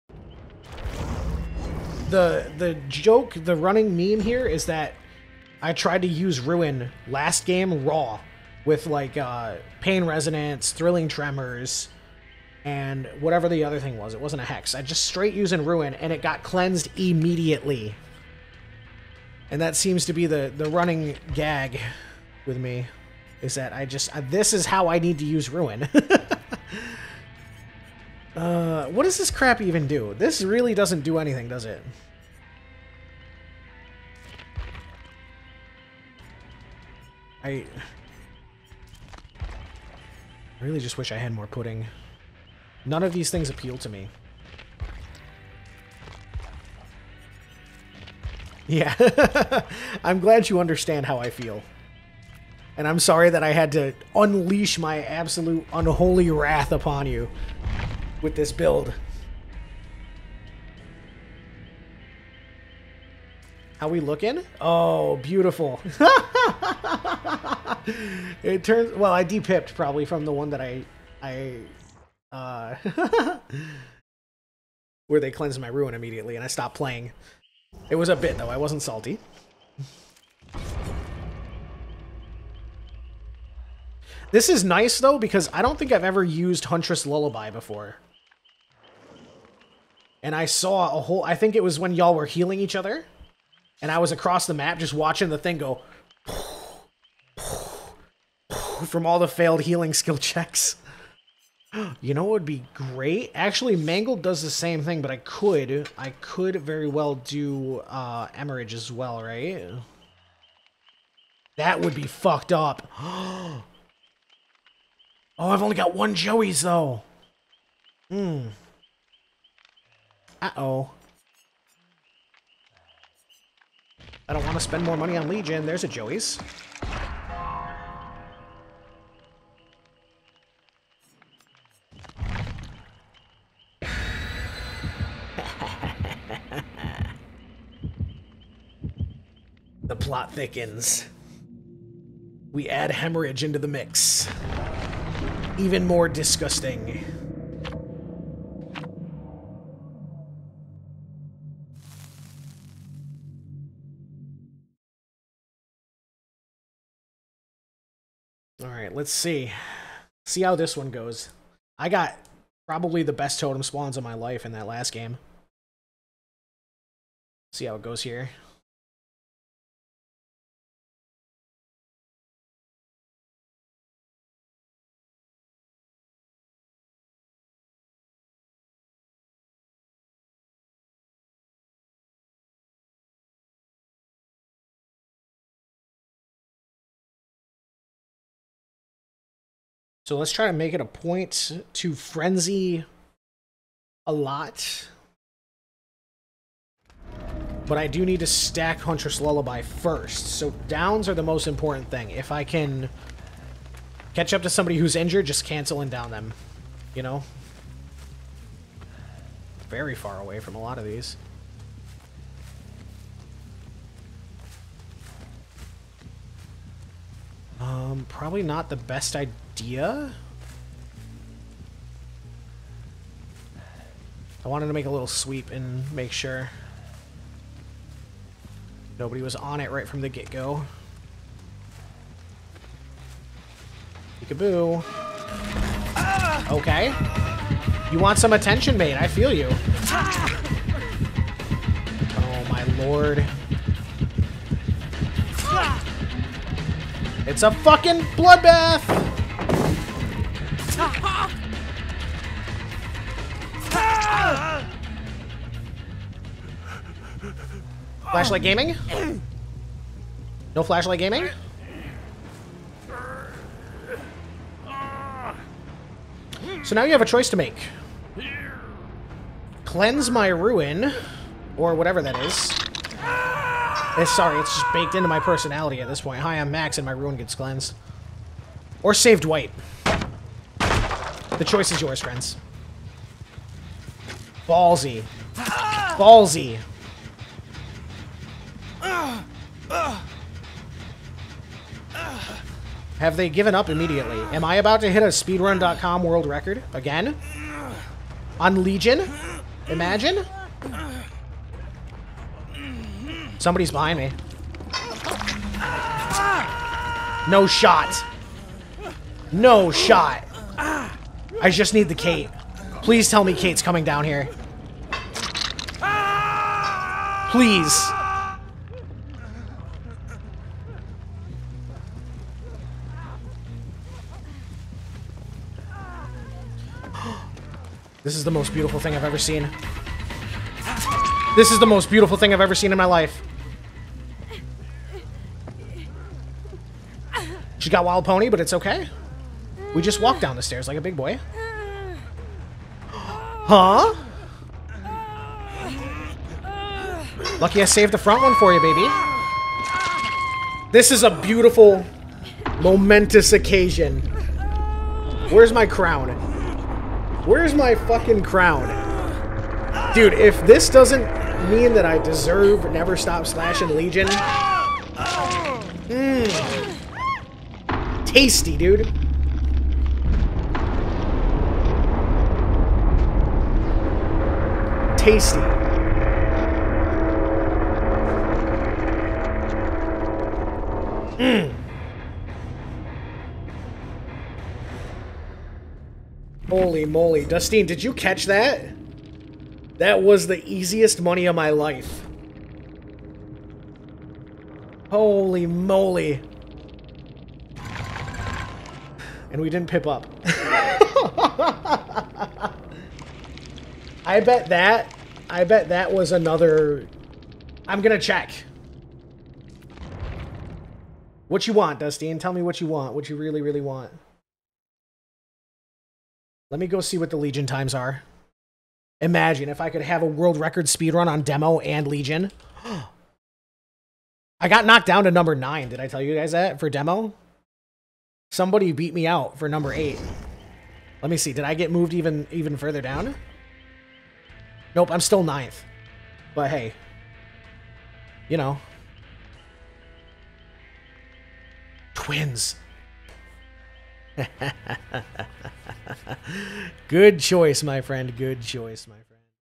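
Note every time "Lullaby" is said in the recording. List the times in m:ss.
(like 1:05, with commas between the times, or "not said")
1:27, 3:19.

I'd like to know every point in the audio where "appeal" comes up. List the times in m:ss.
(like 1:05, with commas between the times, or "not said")
0:43.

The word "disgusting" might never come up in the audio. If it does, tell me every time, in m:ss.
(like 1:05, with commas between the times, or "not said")
2:26.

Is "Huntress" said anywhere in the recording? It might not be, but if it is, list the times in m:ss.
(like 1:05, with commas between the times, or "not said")
1:26, 3:18.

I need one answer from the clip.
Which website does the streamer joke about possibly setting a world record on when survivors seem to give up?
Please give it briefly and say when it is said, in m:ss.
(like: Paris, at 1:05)
speedrun.com, at 4:55.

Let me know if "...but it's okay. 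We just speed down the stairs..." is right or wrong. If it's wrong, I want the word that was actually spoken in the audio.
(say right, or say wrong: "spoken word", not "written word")
wrong: "walked", not "speed".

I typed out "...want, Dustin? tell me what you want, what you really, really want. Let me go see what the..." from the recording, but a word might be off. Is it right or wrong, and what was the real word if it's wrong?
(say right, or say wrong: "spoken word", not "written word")
right.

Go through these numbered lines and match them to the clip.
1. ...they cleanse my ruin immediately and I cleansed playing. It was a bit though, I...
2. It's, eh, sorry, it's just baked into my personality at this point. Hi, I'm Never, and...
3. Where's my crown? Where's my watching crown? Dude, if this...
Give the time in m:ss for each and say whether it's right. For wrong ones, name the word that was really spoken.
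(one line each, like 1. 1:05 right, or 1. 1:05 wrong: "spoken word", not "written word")
1. 1:15 wrong: "stopped", not "cleansed"
2. 4:33 wrong: "Max", not "Never"
3. 5:55 wrong: "fucking", not "watching".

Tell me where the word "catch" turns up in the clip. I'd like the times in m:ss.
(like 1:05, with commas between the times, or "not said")
3:24, 6:27.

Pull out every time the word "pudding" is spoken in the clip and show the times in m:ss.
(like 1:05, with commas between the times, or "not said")
0:41.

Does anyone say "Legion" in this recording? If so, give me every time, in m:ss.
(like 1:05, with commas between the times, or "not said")
2:05, 4:58, 6:03, 6:57, 7:01.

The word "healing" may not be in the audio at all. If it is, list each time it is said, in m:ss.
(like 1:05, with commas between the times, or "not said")
1:32, 1:39.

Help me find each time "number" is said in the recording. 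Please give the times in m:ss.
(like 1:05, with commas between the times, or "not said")
7:05, 7:09.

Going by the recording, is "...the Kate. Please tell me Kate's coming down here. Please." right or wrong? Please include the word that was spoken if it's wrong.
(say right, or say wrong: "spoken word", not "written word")
right.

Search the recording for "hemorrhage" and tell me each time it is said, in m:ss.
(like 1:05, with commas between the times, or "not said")
1:48, 2:22.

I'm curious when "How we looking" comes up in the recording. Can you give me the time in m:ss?
1:03.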